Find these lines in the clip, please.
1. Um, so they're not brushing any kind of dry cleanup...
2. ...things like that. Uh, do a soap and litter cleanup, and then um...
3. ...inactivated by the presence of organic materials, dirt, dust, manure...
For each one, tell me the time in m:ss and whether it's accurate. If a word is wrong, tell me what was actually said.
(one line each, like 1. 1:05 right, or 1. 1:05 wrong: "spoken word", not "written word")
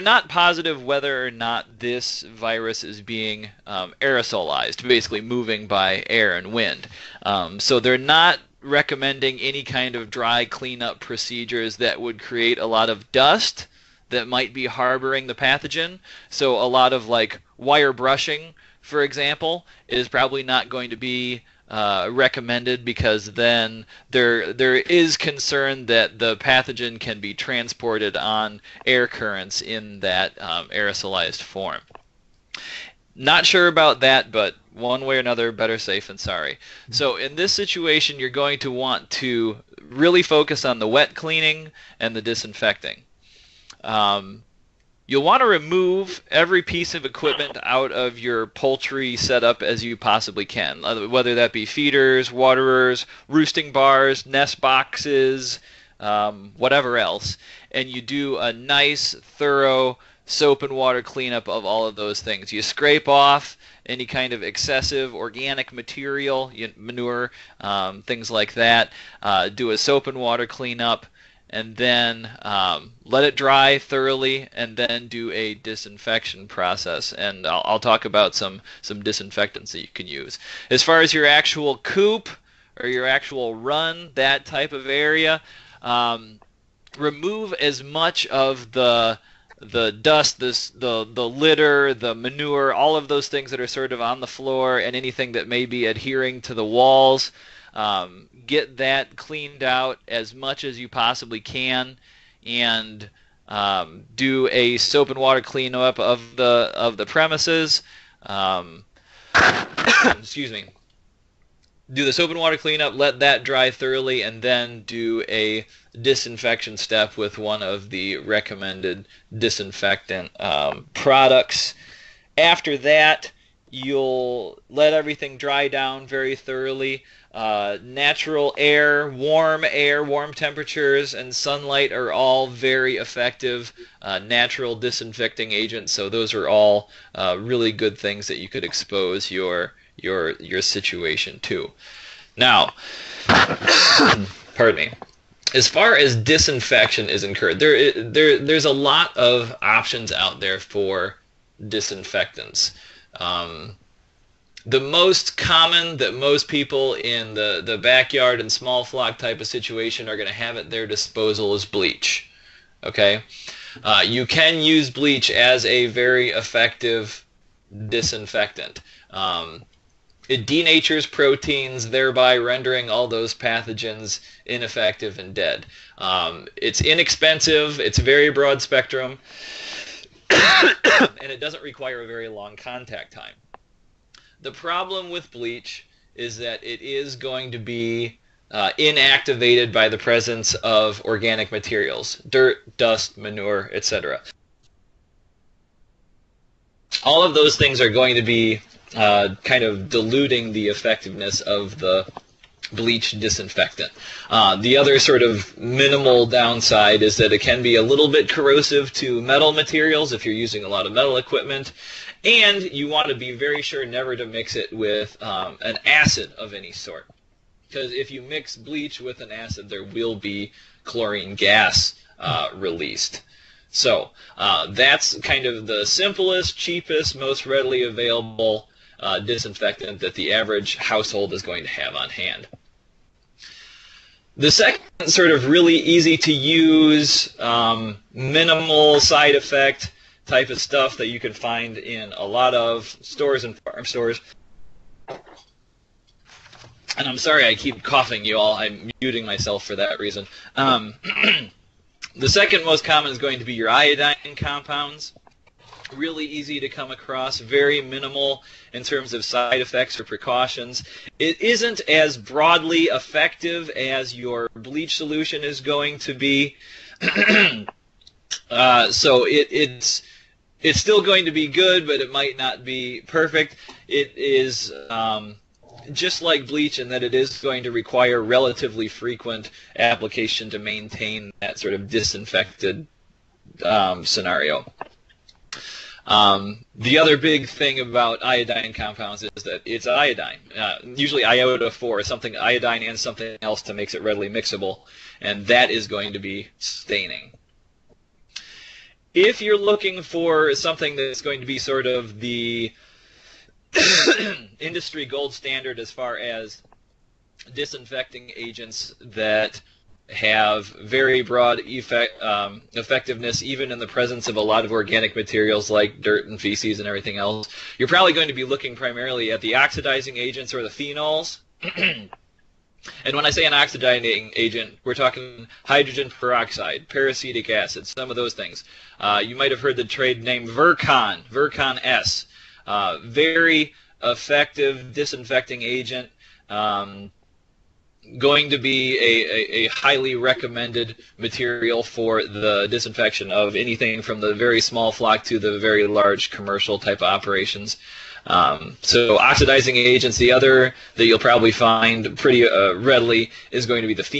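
1. 0:07 wrong: "recommending", not "brushing"
2. 1:08 wrong: "water", not "litter"
3. 3:08 right.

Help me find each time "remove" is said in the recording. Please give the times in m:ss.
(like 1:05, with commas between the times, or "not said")
0:45, 1:26.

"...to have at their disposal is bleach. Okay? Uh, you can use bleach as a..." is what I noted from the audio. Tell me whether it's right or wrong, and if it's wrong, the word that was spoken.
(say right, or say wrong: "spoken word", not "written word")
right.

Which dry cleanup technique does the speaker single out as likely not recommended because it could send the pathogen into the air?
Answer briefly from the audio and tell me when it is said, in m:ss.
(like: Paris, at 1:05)
Wire brushing, at 0:17.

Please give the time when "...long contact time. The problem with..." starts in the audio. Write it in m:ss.
3:02.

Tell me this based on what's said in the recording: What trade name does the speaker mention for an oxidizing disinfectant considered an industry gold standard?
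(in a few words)
Vercon S.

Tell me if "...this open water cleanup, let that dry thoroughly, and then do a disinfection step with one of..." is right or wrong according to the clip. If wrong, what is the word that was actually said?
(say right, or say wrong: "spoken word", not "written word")
right.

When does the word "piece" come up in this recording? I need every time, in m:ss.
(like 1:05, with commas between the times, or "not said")
0:46.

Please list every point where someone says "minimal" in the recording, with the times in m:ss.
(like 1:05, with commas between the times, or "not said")
3:25, 3:58, 4:17.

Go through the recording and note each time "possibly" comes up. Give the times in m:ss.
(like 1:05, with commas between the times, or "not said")
0:49, 1:40.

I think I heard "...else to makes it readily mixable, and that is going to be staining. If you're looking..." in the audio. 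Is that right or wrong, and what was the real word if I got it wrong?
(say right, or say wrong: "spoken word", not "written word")
right.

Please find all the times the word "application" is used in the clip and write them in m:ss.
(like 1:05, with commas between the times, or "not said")
4:39.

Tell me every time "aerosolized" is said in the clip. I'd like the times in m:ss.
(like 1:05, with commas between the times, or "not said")
0:04, 0:30.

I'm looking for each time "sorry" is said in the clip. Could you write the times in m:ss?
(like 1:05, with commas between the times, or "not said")
0:36, 4:07.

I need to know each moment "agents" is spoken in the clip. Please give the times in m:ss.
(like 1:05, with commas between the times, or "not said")
2:15, 5:08, 5:20, 5:24, 5:35, 5:49.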